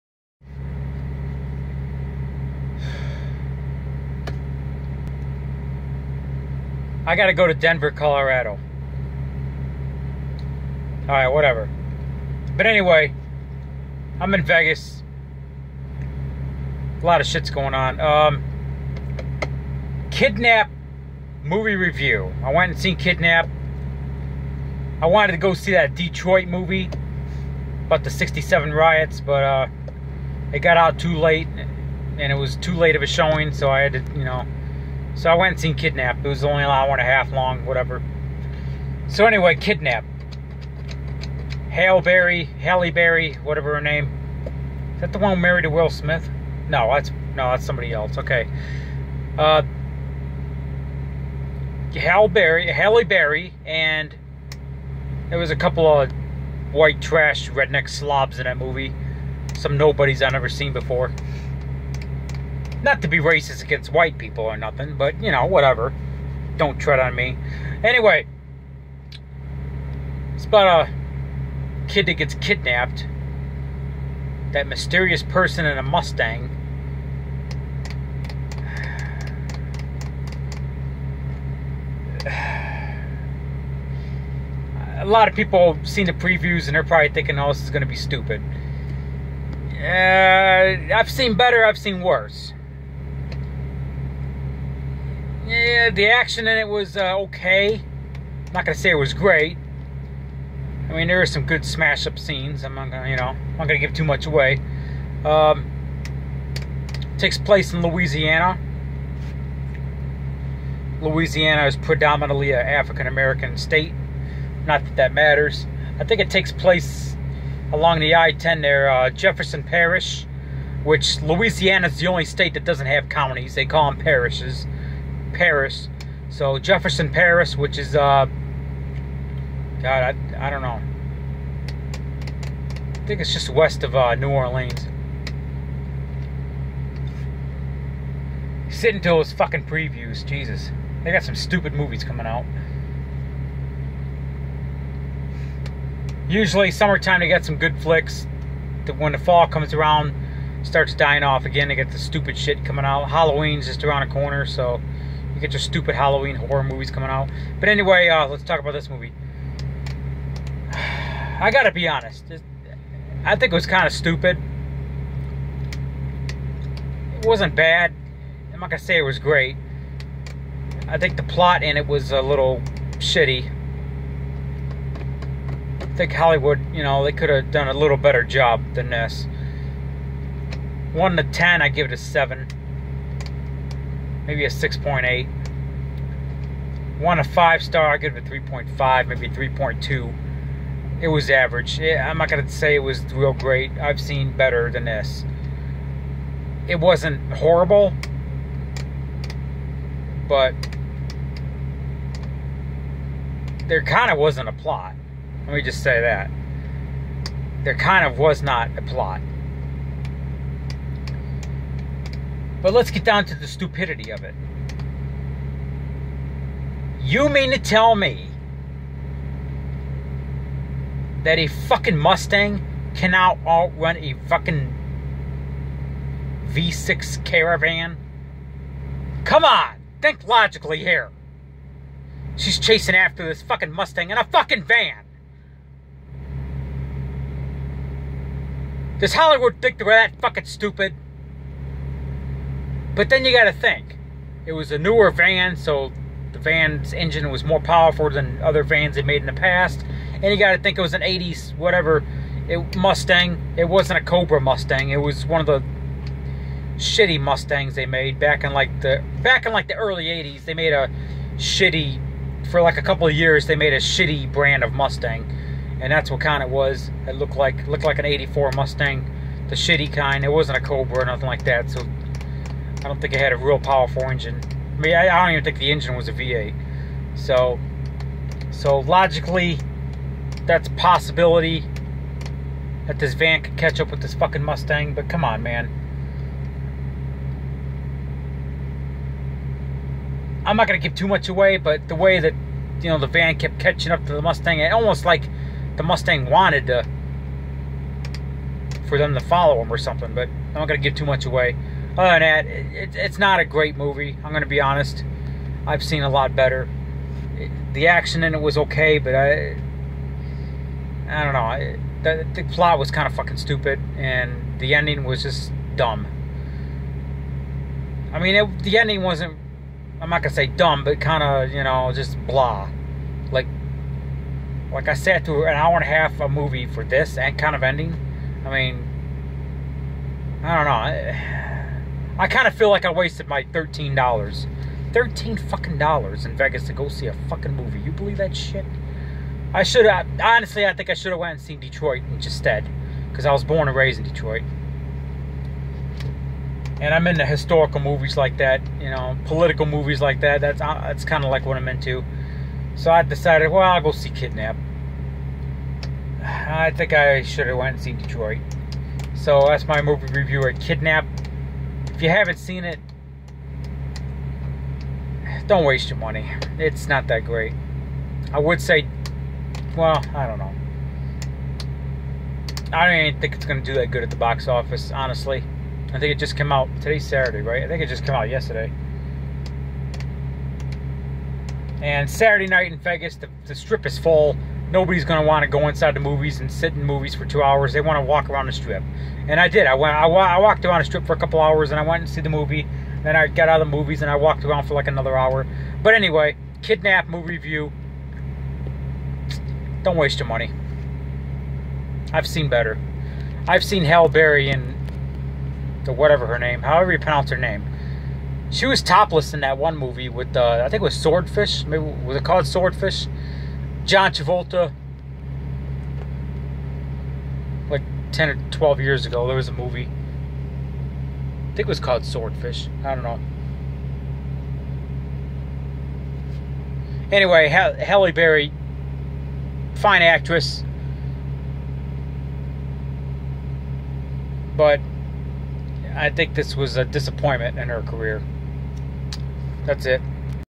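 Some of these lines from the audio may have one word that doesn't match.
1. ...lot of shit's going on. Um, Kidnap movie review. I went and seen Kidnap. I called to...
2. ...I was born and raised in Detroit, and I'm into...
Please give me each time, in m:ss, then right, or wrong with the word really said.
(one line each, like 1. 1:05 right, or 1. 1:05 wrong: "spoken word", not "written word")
1. 0:17 wrong: "wanted", not "called"
2. 5:43 right.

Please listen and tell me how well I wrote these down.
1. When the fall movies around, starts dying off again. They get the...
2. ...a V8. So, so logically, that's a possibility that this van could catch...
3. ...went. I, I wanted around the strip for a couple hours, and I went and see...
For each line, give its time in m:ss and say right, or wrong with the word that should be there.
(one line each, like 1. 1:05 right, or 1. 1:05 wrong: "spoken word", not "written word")
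1. 2:28 wrong: "comes", not "movies"
2. 4:36 right
3. 6:29 wrong: "walked", not "wanted".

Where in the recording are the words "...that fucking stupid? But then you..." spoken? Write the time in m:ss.
3:59.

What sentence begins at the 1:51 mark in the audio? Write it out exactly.
Louisiana is predominantly an African American state.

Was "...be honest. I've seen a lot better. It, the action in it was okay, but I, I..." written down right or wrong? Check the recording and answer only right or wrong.
right.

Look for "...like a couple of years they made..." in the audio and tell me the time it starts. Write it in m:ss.
4:22.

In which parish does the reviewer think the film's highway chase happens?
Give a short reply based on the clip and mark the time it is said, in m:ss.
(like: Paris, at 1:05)
Jefferson Parish, at 1:59.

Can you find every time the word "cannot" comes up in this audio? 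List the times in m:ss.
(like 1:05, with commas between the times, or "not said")
3:42.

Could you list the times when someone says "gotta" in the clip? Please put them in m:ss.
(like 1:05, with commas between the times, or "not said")
0:07, 2:41.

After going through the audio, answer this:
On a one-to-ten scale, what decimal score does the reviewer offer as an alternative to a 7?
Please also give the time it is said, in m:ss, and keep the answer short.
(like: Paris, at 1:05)
6.8, at 3:04.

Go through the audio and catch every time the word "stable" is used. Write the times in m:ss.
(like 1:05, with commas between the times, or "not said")
not said.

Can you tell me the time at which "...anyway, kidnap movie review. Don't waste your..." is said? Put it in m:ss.
6:35.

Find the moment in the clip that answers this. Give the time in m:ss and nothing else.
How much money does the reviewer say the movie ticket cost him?
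5:33.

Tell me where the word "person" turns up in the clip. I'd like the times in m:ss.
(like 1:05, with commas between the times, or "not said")
1:15.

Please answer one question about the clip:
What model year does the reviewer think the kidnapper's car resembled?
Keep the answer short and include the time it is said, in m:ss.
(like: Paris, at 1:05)
84, at 4:28.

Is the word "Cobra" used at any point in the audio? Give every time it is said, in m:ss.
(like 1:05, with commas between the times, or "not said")
4:14, 4:30.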